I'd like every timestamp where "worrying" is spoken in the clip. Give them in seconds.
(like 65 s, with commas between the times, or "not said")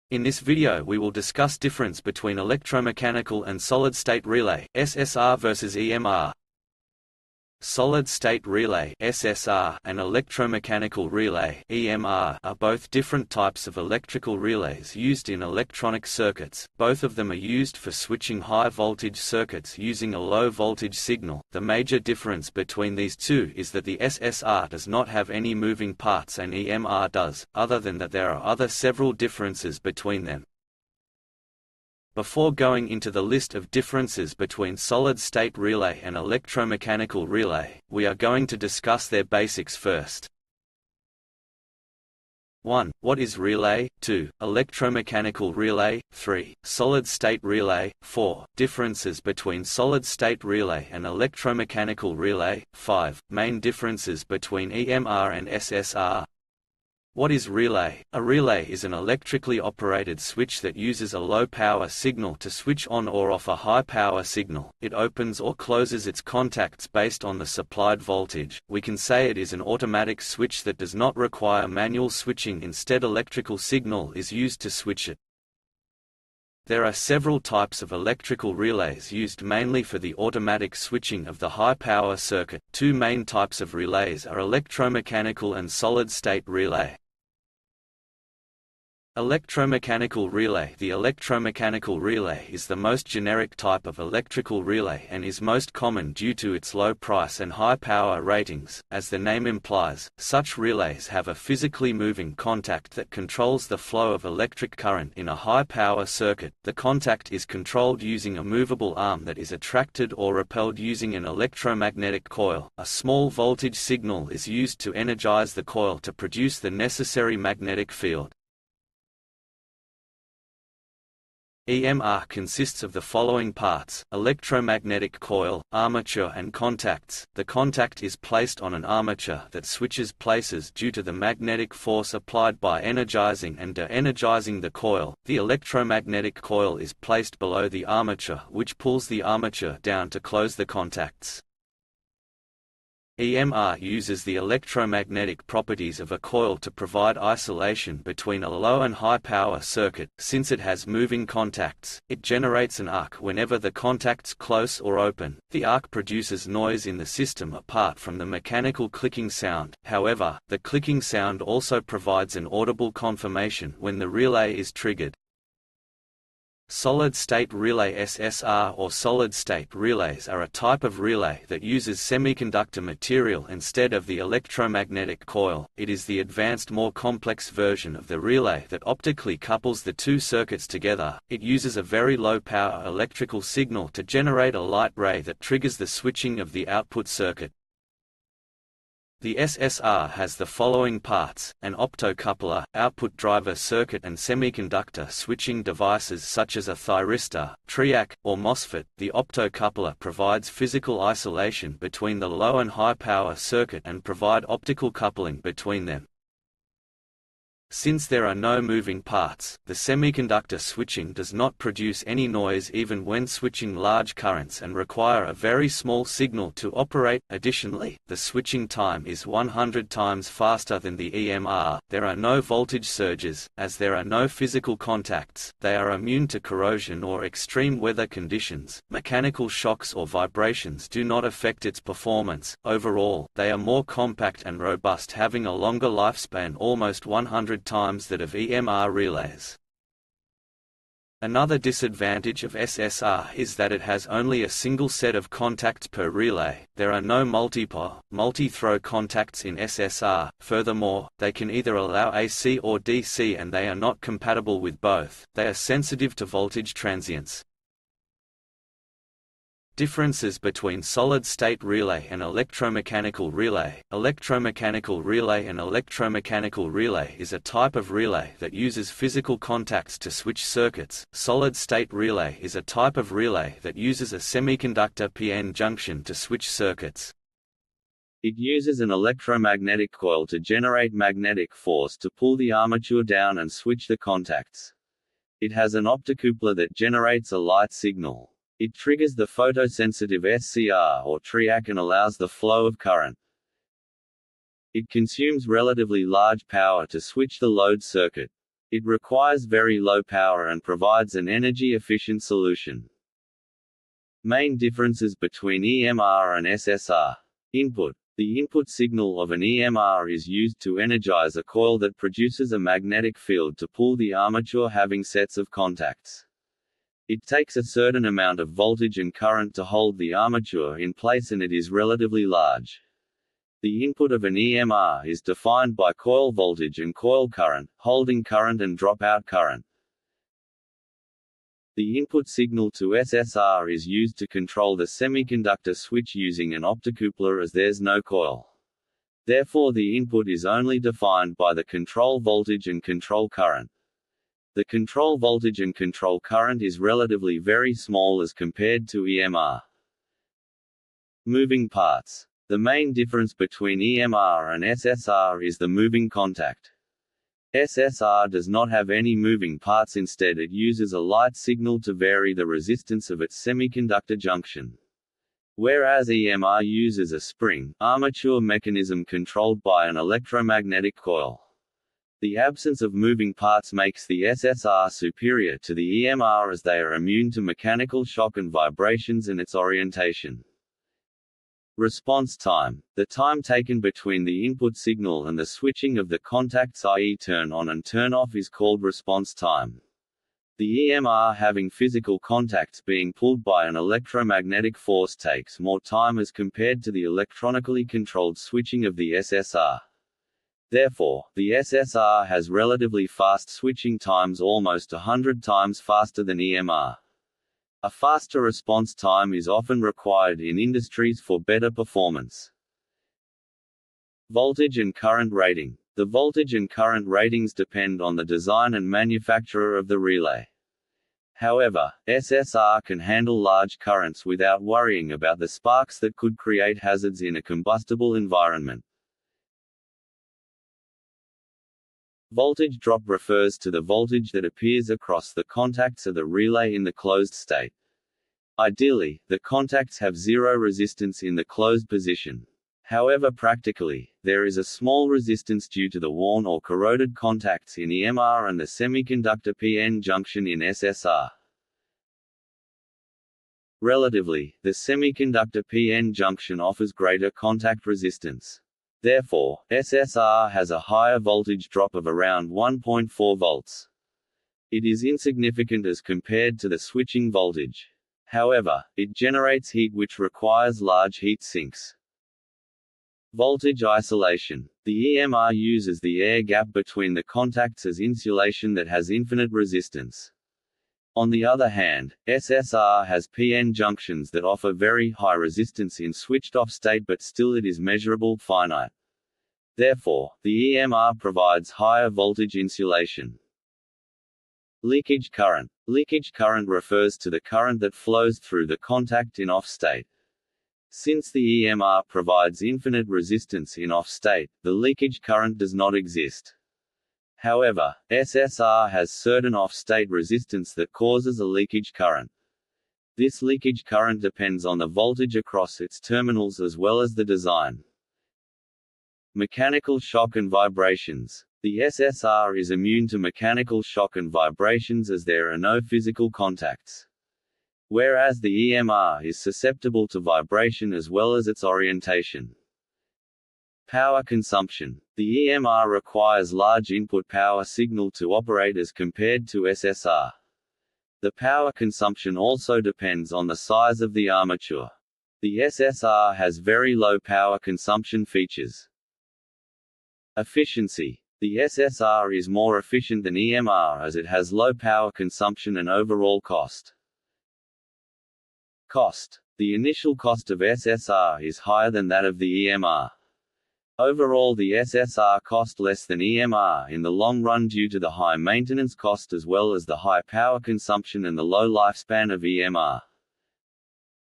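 424 s.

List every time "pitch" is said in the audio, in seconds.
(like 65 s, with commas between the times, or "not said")
not said.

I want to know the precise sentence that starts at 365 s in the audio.
Whereas EMR uses a spring, armature mechanism controlled by an electromagnetic coil.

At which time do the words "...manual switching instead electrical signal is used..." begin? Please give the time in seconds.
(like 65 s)
71 s.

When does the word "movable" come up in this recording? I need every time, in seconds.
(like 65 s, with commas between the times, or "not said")
108 s.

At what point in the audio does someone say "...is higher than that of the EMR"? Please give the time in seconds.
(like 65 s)
561 s.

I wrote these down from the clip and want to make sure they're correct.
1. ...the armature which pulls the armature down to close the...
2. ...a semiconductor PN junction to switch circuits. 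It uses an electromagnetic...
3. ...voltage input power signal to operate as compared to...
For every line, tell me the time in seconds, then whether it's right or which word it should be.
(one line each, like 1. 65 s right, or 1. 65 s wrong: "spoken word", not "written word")
1. 137 s right
2. 274 s right
3. 536 s wrong: "large", not "voltage".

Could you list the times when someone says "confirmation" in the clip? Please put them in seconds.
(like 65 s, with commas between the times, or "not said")
162 s.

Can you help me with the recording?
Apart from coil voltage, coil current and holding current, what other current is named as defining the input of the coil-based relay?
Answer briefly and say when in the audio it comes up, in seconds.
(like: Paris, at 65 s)
dropout current, at 328 s.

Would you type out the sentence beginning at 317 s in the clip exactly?
It takes a certain amount of voltage and current to hold the armature in place and it is relatively large.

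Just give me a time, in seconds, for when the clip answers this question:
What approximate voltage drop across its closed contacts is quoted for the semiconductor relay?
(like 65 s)
462 s.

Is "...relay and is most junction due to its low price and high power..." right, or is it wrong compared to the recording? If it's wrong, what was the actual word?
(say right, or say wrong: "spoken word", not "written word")
wrong: "common", not "junction".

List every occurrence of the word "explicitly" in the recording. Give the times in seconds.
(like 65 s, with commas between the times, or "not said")
not said.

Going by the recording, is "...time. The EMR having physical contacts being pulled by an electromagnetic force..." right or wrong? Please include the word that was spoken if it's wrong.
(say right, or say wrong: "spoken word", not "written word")
right.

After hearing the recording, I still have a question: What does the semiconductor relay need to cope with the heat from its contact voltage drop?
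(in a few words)
large heat sinks.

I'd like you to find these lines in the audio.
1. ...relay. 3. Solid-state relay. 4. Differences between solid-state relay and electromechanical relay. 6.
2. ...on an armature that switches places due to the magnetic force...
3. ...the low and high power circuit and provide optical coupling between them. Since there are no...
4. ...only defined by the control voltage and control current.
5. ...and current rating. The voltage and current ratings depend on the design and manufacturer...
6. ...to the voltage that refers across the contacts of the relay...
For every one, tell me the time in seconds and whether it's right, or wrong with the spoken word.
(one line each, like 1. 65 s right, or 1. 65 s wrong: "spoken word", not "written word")
1. 45 s wrong: "5", not "6"
2. 128 s right
3. 202 s right
4. 340 s right
5. 414 s right
6. 433 s wrong: "appears", not "refers".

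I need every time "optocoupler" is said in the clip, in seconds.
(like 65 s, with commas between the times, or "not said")
191 s, 199 s, 285 s, 336 s.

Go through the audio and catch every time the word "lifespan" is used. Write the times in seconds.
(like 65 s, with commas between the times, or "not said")
235 s, 571 s.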